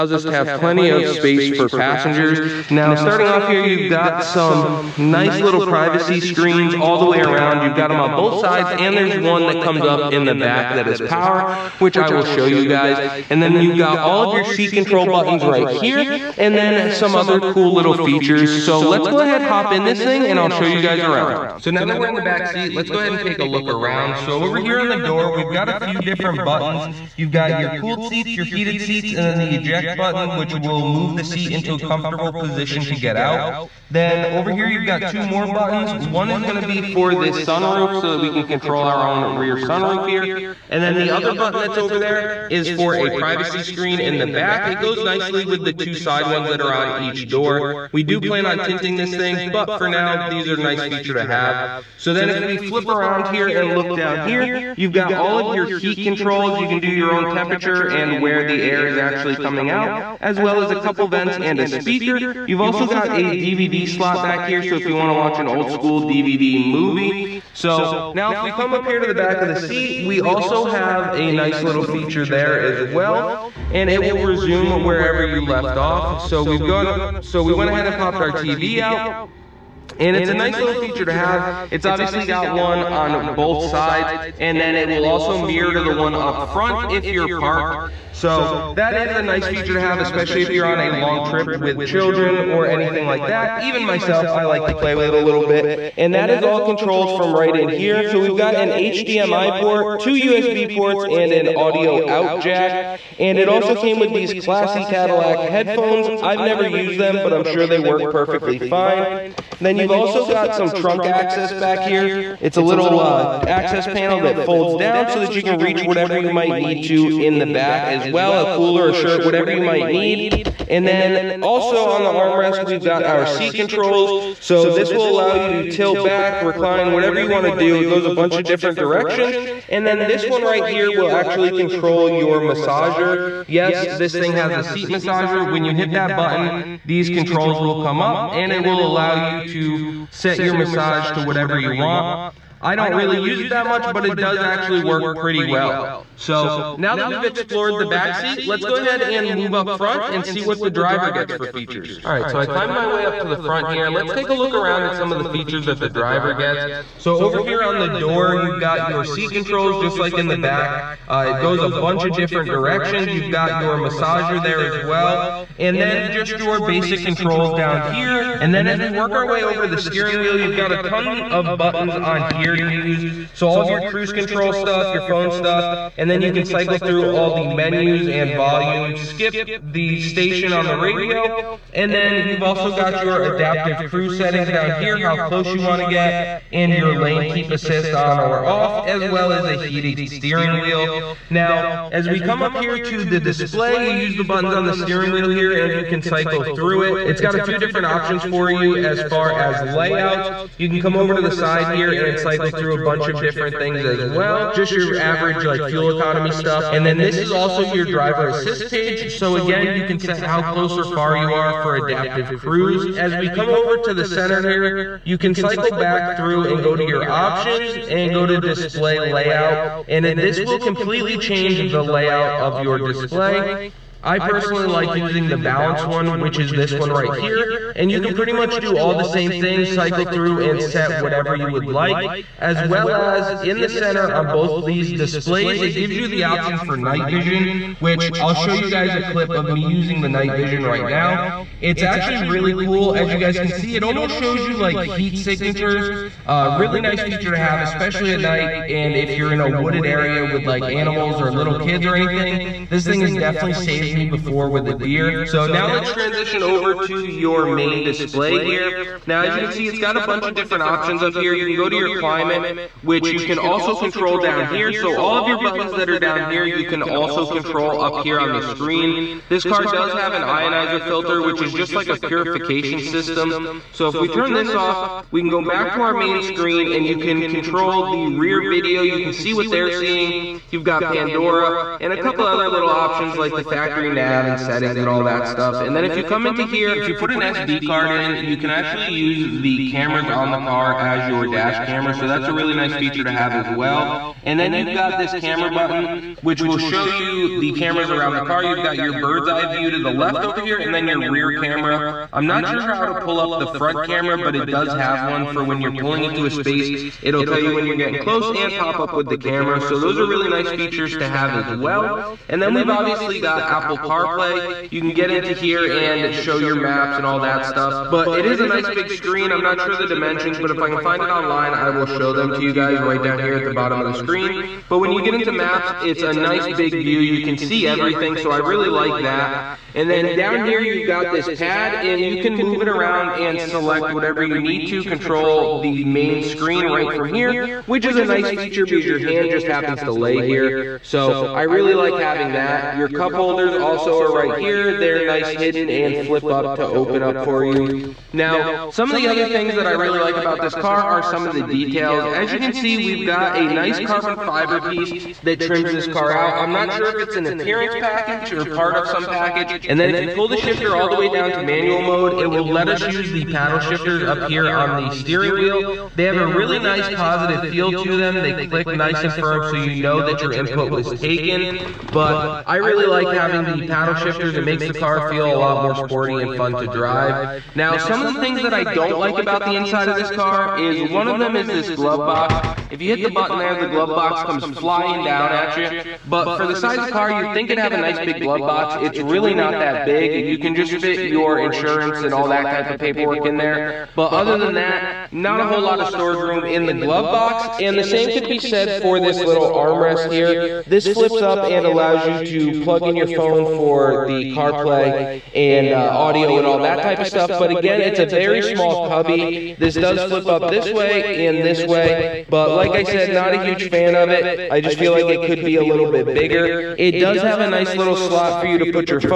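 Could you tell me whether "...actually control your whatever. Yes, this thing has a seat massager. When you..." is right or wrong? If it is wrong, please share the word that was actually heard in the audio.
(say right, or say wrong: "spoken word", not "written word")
wrong: "massager", not "whatever".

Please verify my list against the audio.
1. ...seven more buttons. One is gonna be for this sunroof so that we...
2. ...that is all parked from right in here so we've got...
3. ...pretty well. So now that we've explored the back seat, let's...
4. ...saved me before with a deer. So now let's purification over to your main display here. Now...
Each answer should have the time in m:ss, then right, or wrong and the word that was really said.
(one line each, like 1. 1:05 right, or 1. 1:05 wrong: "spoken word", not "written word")
1. 0:35 wrong: "two", not "seven"
2. 1:36 wrong: "controlled", not "parked"
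3. 2:25 right
4. 4:13 wrong: "transition", not "purification".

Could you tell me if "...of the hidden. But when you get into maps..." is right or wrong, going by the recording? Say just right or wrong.
wrong.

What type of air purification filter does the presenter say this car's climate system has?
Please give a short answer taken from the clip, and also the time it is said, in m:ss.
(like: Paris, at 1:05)
ionizer filter, at 4:30.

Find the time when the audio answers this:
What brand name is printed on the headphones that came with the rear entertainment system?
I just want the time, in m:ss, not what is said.
1:44.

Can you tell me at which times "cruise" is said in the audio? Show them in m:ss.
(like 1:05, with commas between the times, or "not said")
2:53, 3:03, 3:32.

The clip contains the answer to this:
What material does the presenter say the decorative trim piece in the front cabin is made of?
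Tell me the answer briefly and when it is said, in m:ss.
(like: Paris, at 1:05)
carbon fiber, at 5:53.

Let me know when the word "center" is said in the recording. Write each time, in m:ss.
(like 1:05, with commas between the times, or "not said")
3:34, 3:53.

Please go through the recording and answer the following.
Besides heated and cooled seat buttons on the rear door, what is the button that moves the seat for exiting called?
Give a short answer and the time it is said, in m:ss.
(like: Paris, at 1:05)
eject button, at 0:29.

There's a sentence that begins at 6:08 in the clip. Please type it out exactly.
They click nice and firm so you know that your input was taken.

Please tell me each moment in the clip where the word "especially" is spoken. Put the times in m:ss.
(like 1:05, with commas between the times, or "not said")
1:29, 4:07.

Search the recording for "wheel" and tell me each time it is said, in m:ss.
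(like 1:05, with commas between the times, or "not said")
2:50, 3:10, 3:15, 6:05.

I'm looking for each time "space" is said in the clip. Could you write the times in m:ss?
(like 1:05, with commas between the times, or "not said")
0:01, 5:06.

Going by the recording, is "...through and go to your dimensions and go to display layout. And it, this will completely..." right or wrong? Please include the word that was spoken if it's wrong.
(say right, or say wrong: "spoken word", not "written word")
wrong: "options", not "dimensions".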